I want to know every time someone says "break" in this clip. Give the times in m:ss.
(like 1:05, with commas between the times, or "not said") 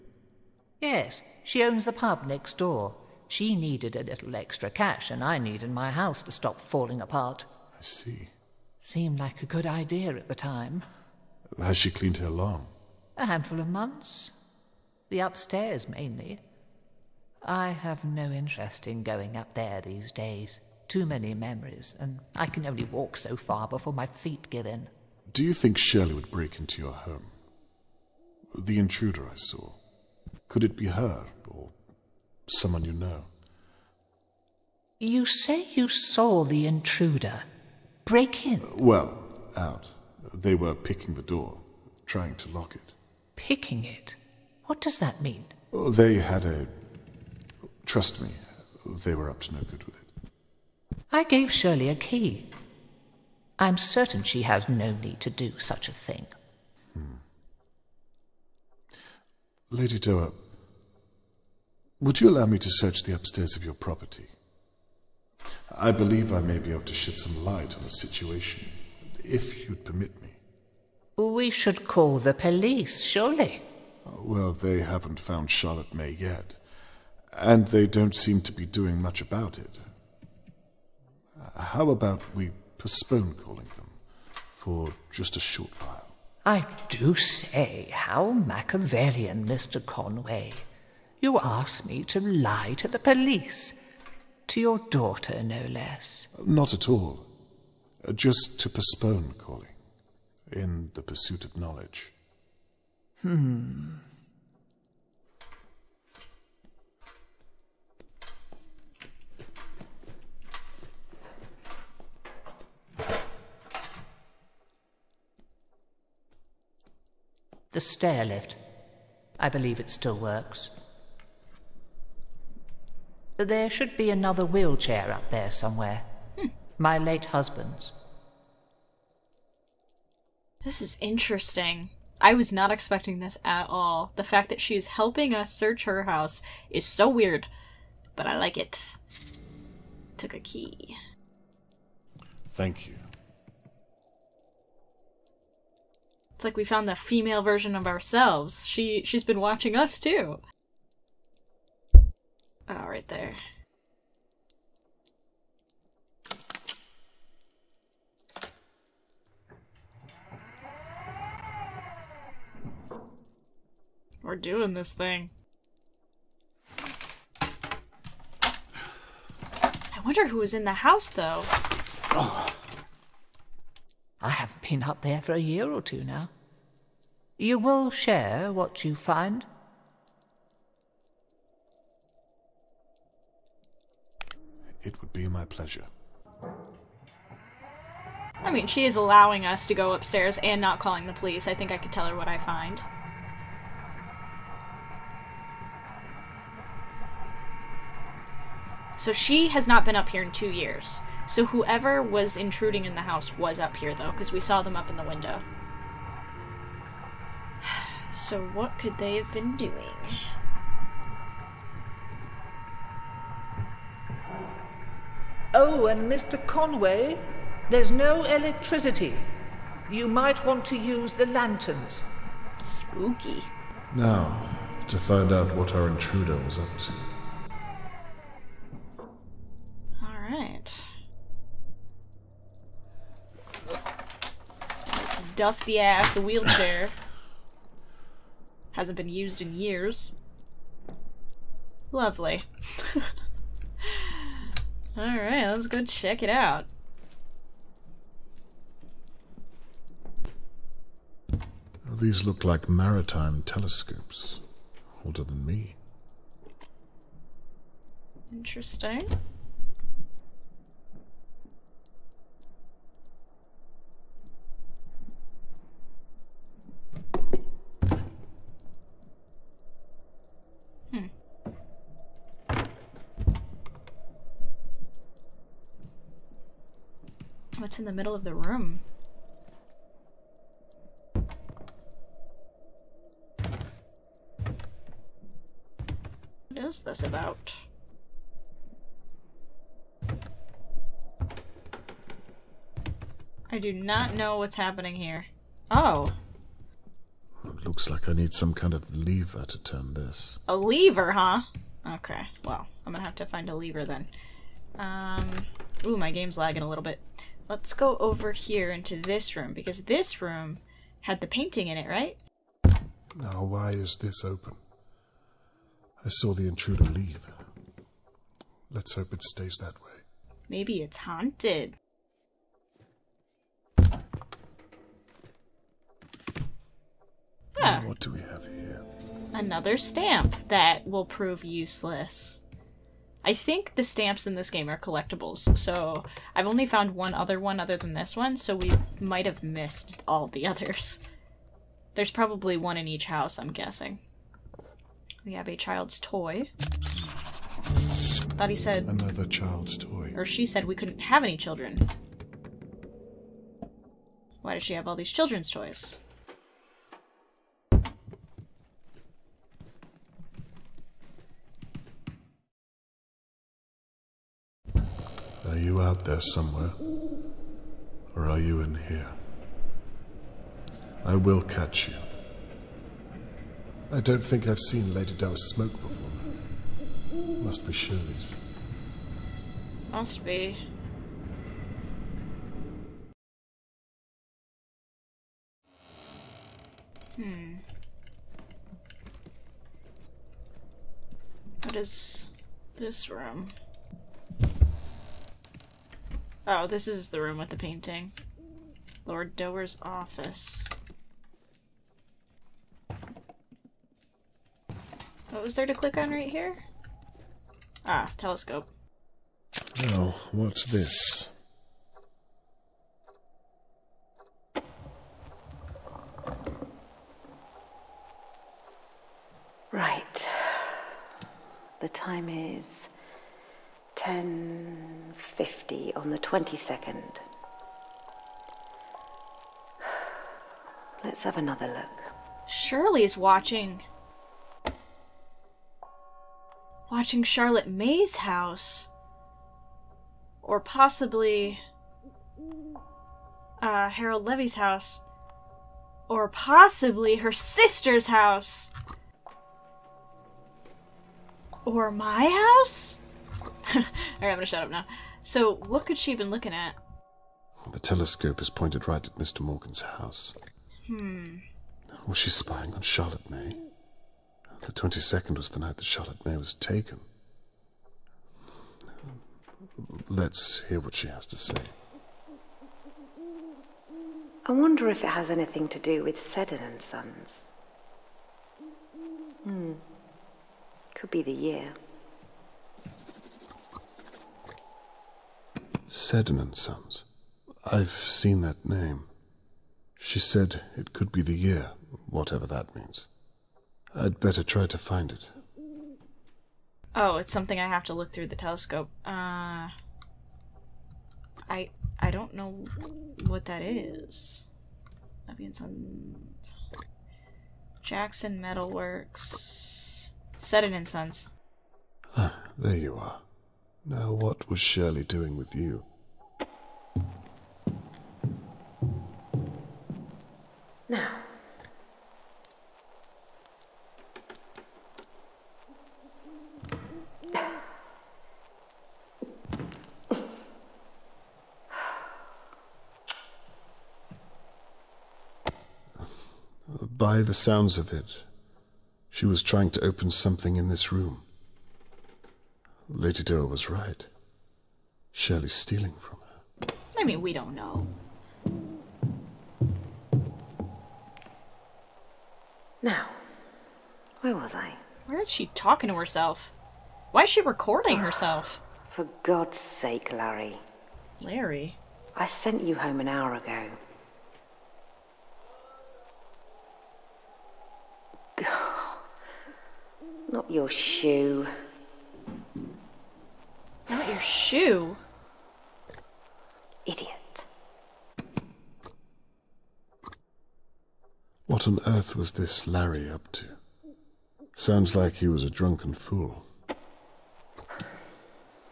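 0:26, 0:38.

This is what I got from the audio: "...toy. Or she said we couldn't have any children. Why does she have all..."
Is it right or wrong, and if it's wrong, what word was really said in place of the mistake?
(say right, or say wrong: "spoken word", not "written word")
right.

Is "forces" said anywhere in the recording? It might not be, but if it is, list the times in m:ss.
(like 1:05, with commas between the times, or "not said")
not said.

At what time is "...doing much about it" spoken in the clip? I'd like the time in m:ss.
1:18.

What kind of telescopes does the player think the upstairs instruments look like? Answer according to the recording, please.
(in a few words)
Maritime telescopes.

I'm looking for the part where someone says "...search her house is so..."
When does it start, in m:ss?
2:15.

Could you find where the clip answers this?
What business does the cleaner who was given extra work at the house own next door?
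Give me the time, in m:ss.
0:01.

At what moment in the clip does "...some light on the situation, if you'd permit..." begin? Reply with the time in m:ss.
1:07.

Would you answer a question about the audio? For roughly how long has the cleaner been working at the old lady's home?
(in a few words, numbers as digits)
A handful of months.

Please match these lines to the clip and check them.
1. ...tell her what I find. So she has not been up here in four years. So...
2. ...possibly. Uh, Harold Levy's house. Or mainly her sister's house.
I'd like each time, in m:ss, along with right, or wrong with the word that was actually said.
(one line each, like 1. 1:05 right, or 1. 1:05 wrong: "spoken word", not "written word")
1. 3:11 wrong: "two", not "four"
2. 7:20 wrong: "possibly", not "mainly".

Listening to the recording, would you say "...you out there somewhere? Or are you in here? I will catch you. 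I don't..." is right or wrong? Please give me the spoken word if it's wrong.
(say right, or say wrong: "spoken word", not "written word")
right.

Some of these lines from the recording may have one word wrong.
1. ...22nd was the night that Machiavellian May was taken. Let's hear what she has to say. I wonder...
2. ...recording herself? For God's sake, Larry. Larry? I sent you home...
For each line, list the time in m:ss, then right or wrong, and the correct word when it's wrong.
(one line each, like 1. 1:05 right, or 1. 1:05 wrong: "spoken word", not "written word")
1. 7:44 wrong: "Charlotte", not "Machiavellian"
2. 9:17 right.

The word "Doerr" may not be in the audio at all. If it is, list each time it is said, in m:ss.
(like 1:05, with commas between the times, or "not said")
0:59, 6:15, 6:39, 9:03.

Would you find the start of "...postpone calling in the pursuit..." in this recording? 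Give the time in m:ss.
1:38.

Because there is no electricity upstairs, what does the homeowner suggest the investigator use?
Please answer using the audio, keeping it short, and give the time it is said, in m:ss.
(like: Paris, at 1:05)
Lanterns, at 3:41.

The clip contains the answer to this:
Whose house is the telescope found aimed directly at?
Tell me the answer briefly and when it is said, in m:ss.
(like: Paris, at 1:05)
Mr. Morgan's, at 7:39.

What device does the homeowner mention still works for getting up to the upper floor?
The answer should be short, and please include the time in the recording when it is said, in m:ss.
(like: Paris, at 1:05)
The stair lift, at 1:57.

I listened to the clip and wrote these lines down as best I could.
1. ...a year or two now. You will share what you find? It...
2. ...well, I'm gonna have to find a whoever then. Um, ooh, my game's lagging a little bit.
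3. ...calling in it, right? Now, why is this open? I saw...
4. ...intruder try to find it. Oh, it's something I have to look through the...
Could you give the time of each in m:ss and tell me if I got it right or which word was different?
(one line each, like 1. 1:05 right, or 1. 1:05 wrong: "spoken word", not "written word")
1. 2:55 right
2. 5:02 wrong: "lever", not "whoever"
3. 5:11 wrong: "painting", not "calling"
4. 8:14 wrong: "better", not "intruder".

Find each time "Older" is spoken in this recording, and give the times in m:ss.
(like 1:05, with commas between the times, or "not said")
4:15.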